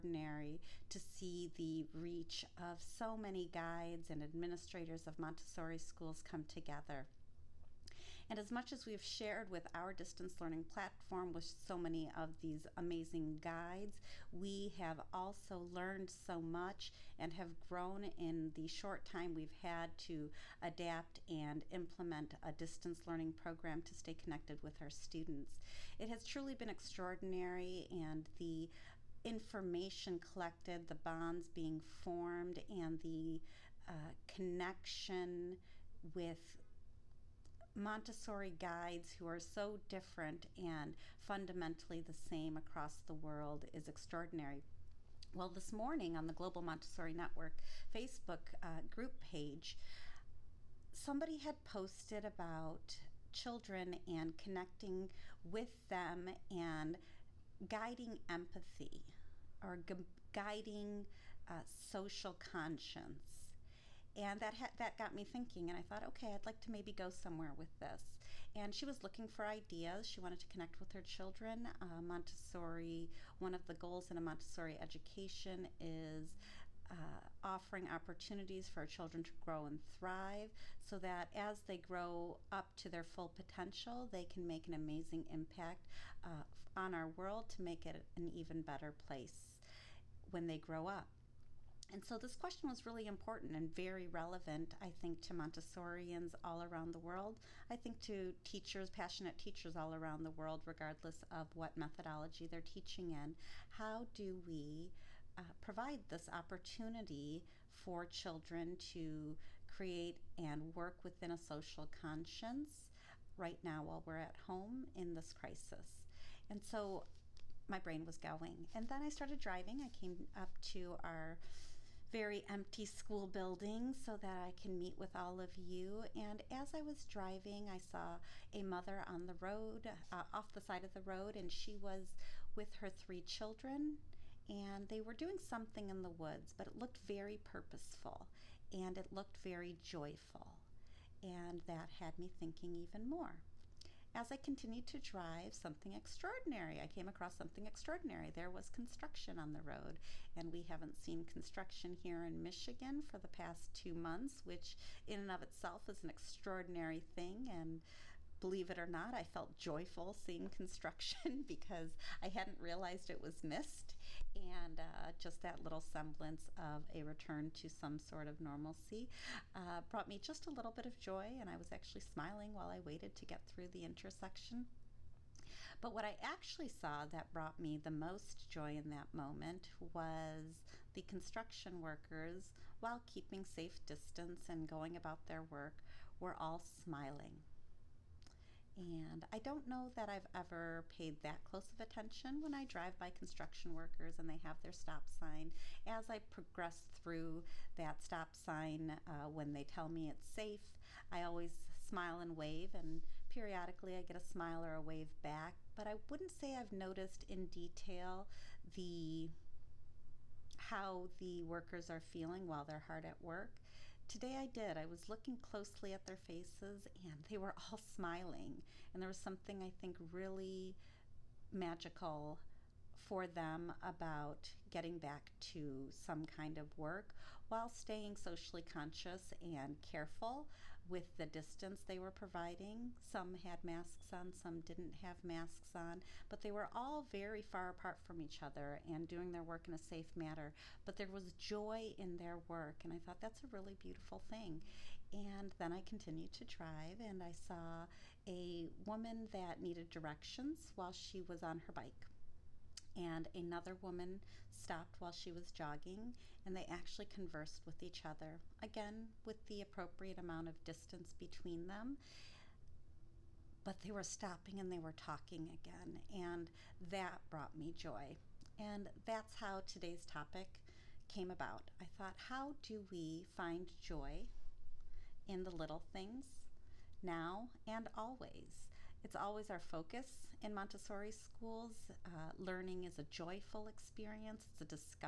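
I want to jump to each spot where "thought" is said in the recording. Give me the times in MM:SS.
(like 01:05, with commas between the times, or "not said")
01:05, 04:02, 04:31.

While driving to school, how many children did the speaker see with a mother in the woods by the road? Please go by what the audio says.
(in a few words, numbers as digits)
3.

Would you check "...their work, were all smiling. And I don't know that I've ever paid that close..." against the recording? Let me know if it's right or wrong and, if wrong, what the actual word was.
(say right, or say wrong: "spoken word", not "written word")
right.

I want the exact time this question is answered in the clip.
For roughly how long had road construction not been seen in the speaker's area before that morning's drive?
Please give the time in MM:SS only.
02:33.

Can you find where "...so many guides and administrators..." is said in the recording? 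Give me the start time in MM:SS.
00:02.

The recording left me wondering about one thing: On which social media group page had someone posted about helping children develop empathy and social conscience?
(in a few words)
Global Montessori Network.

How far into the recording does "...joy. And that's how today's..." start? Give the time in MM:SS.
04:27.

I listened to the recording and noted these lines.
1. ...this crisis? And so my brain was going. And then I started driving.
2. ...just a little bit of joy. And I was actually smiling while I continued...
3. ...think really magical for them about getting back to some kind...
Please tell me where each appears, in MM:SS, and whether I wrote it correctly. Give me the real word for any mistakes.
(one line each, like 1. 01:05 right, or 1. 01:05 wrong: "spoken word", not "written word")
1. 01:55 right
2. 02:50 wrong: "waited", not "continued"
3. 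03:39 right.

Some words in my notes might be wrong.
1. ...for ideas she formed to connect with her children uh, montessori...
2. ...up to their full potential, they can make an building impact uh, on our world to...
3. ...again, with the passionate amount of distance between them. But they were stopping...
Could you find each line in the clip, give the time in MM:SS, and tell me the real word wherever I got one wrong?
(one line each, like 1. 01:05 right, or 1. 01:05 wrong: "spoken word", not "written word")
1. 01:09 wrong: "wanted", not "formed"
2. 01:22 wrong: "amazing", not "building"
3. 04:18 wrong: "appropriate", not "passionate".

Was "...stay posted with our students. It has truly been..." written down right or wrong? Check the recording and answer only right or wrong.
wrong.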